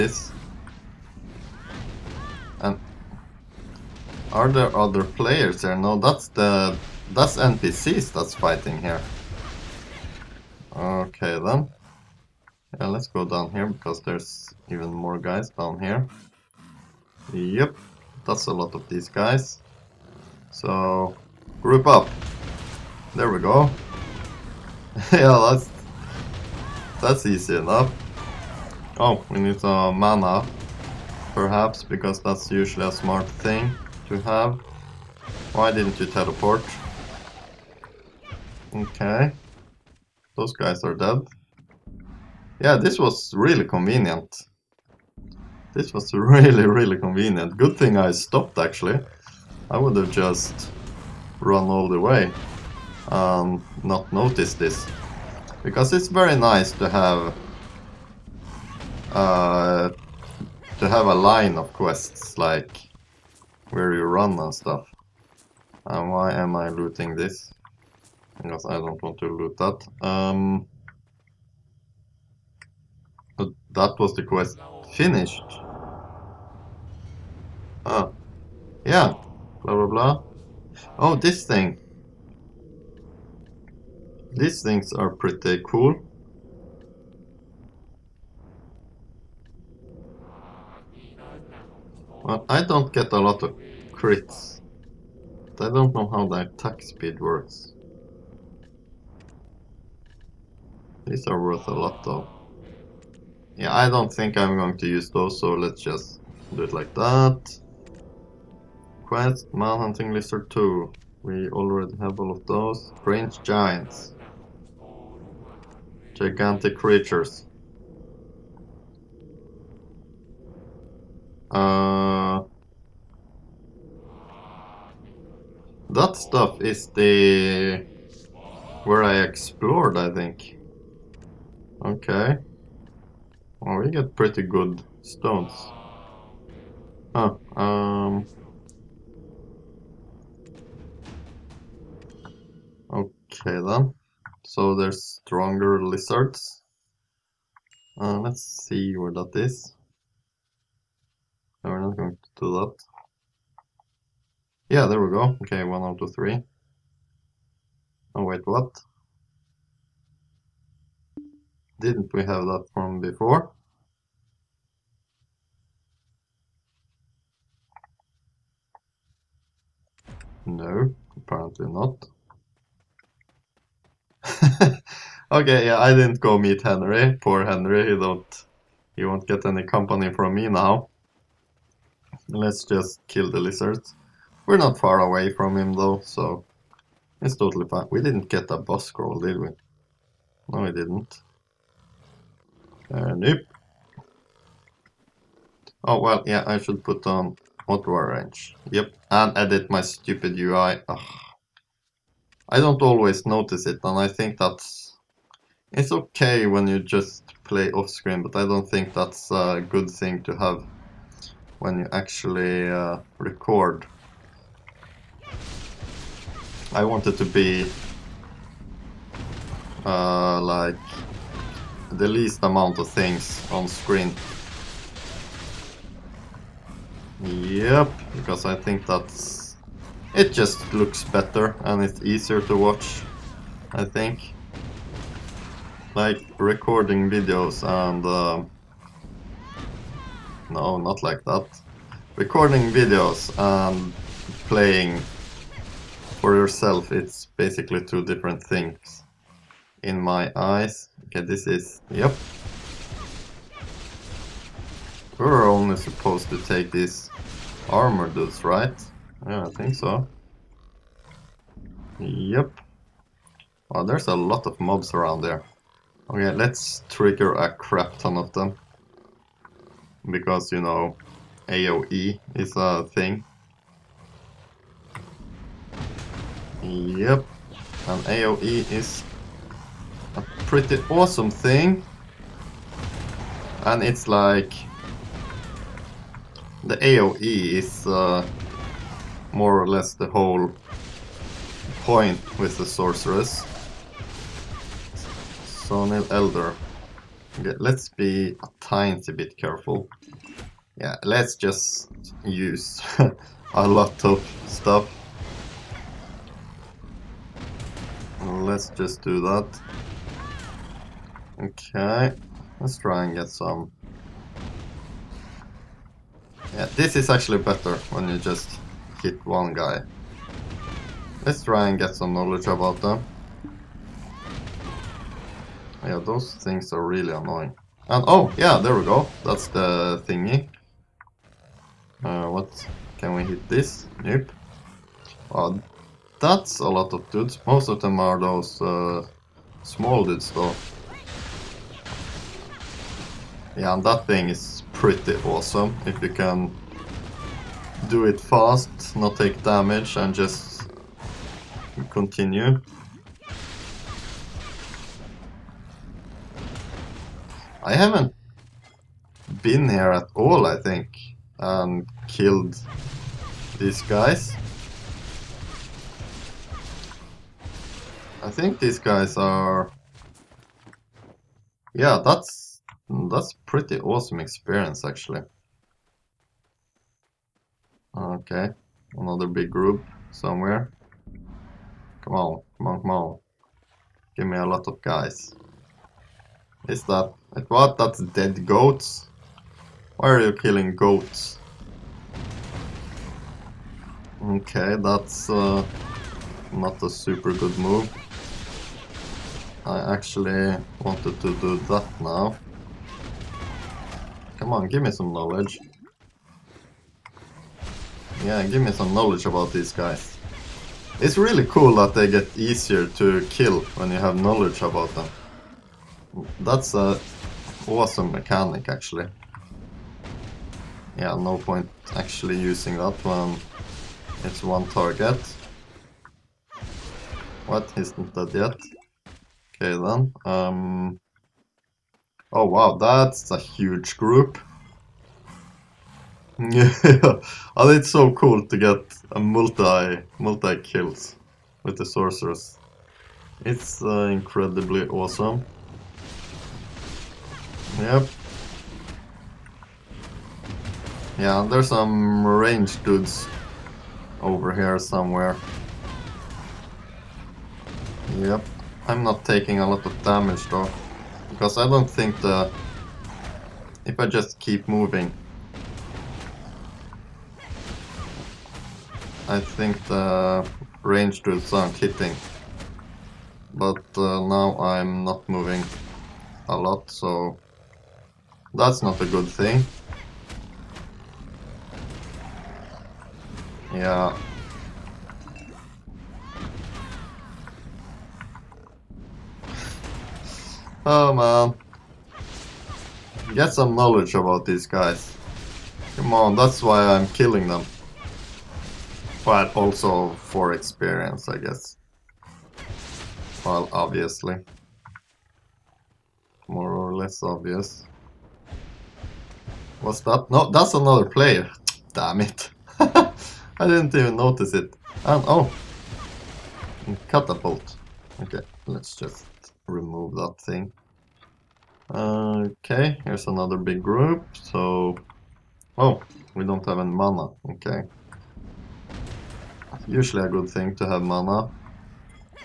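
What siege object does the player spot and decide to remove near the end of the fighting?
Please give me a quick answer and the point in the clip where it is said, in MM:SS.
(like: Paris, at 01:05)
Catapult, at 08:37.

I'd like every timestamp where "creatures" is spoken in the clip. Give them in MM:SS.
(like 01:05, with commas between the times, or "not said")
01:56.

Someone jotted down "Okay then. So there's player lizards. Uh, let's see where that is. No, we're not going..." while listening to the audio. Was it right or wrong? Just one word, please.
wrong.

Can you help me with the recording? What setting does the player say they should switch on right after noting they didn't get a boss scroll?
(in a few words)
Auto range.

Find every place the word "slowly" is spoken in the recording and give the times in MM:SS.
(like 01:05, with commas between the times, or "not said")
not said.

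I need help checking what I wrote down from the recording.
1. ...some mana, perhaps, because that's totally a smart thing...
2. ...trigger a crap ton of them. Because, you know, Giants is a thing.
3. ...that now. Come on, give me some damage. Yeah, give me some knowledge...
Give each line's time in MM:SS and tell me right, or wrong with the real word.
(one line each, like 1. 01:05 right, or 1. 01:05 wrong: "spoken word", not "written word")
1. 00:29 wrong: "usually", not "totally"
2. 04:26 wrong: "AoE", not "Giants"
3. 06:41 wrong: "knowledge", not "damage".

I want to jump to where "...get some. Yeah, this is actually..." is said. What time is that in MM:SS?
05:13.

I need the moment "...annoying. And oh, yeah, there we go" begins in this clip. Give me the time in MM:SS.
05:27.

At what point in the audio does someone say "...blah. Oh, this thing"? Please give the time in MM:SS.
01:19.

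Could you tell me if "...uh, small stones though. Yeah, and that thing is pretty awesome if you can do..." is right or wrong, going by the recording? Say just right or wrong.
wrong.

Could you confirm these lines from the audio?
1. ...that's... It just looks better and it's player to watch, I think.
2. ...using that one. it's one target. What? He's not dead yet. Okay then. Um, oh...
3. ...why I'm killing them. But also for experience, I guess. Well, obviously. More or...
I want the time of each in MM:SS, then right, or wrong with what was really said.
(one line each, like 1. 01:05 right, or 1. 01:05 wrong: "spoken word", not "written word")
1. 03:48 wrong: "easier", not "player"
2. 07:02 right
3. 08:16 right.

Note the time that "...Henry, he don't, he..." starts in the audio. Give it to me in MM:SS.
02:57.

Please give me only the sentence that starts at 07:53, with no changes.
But uh, now I'm not moving a lot, so...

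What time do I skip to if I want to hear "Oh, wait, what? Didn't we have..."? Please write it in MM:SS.
02:38.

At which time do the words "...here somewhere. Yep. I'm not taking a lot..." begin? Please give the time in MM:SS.
07:34.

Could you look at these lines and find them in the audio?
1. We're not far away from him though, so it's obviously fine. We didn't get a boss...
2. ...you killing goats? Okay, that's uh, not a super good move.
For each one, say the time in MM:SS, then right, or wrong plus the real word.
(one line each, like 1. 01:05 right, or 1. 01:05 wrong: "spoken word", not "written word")
1. 03:04 wrong: "totally", not "obviously"
2. 06:30 right.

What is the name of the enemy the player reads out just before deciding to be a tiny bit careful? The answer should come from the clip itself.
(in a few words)
Saunil Elder.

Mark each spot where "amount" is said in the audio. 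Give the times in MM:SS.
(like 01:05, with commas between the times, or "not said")
03:42.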